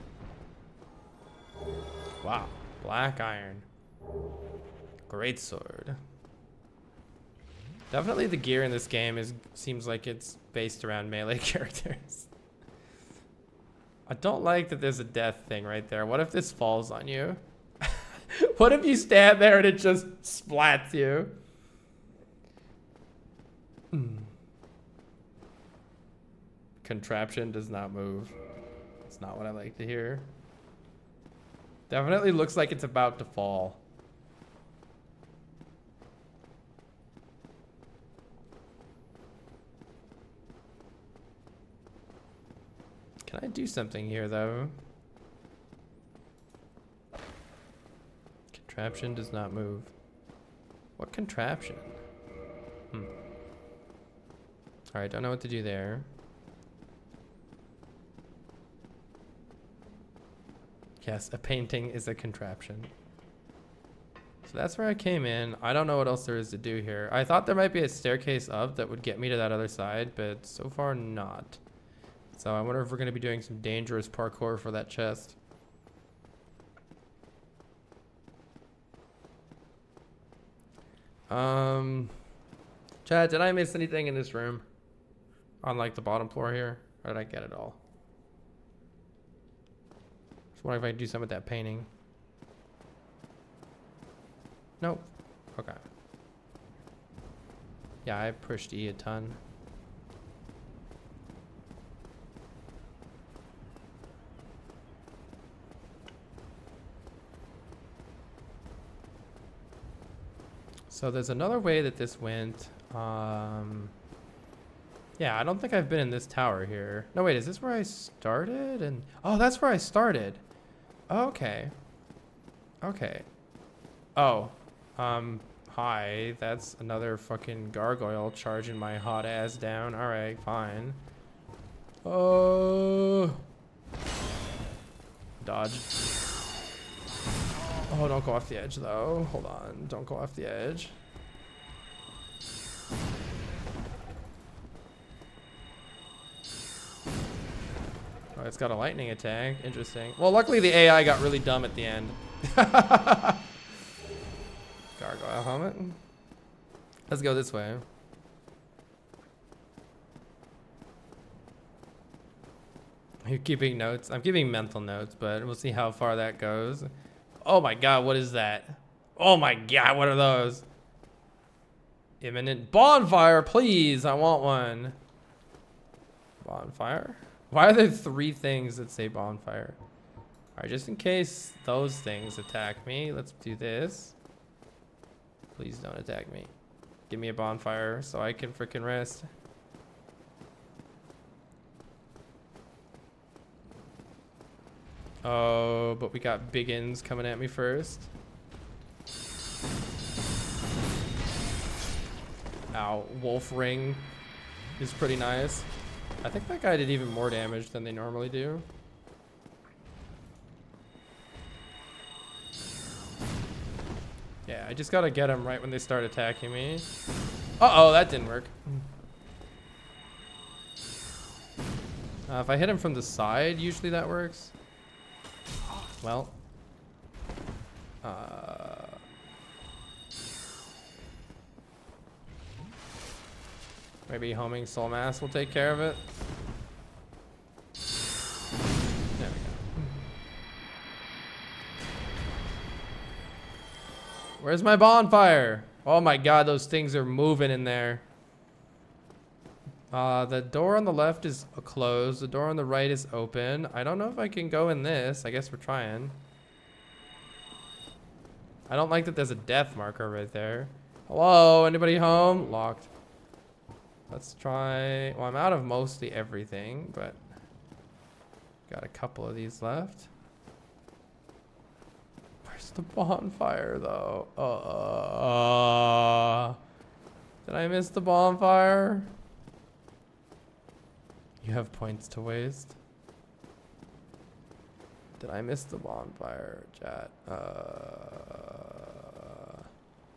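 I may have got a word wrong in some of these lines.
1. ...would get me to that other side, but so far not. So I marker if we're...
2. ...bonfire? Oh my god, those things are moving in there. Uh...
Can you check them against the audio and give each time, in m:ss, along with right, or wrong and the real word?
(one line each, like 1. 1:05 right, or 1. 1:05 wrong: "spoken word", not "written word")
1. 1:08 wrong: "wonder", not "marker"
2. 4:04 right.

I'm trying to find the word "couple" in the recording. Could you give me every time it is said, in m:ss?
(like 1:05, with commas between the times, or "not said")
4:28.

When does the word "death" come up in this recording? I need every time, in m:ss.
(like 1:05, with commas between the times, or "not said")
0:15, 4:19.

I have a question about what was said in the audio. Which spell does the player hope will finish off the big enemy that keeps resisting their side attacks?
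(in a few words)
Homing soul mass.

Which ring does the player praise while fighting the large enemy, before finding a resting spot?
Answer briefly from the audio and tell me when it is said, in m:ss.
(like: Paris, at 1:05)
Wolf Ring, at 3:23.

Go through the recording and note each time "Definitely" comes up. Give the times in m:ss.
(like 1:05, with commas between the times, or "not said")
0:07, 0:31.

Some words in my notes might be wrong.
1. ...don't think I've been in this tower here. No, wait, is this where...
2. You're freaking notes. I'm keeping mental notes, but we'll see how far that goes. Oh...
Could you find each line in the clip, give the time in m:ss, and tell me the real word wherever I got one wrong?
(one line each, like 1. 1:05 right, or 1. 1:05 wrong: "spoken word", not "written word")
1. 1:55 right
2. 2:43 wrong: "keeping", not "freaking".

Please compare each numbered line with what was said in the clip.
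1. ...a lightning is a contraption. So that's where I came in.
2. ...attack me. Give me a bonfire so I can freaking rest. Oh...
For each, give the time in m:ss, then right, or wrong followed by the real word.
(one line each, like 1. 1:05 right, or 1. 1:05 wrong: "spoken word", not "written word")
1. 1:01 wrong: "painting", not "lightning"
2. 3:05 right.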